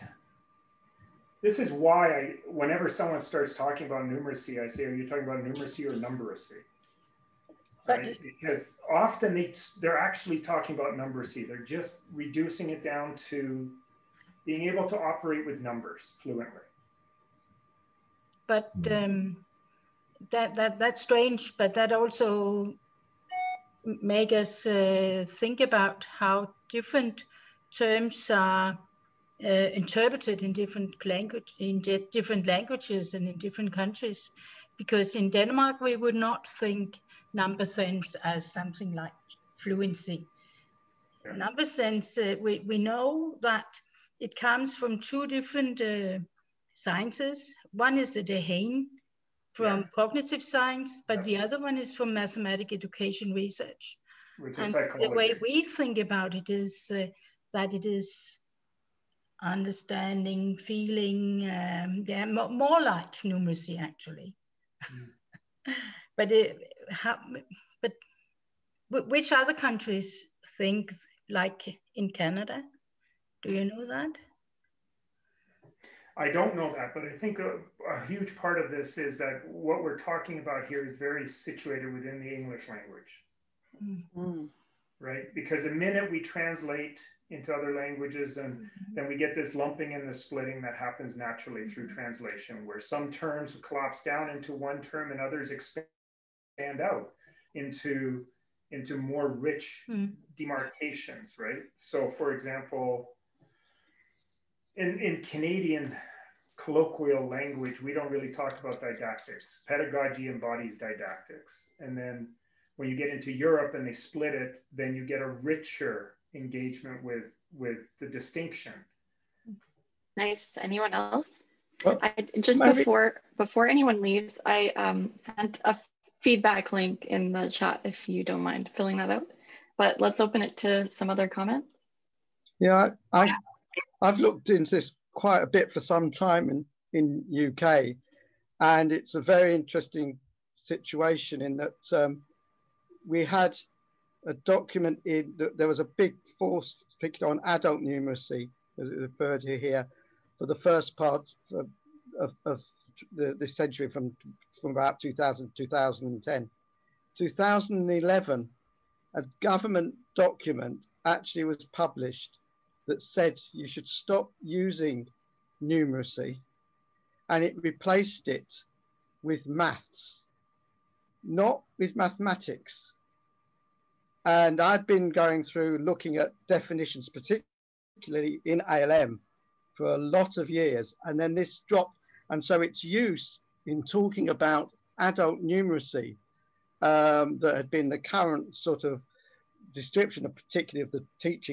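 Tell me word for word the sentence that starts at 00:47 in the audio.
One is the Dehaene from yeah.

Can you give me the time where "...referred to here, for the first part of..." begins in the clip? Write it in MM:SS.
02:28.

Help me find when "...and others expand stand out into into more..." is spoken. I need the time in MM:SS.
01:35.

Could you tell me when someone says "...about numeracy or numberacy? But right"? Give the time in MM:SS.
00:05.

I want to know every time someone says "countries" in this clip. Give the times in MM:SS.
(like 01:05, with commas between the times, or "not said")
00:33, 01:09.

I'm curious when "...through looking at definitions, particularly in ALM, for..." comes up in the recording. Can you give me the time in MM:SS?
02:55.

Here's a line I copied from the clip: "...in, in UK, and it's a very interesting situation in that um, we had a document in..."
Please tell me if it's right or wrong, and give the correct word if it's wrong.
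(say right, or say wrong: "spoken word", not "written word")
right.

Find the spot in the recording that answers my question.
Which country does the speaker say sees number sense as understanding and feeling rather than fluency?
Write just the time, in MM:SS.
00:35.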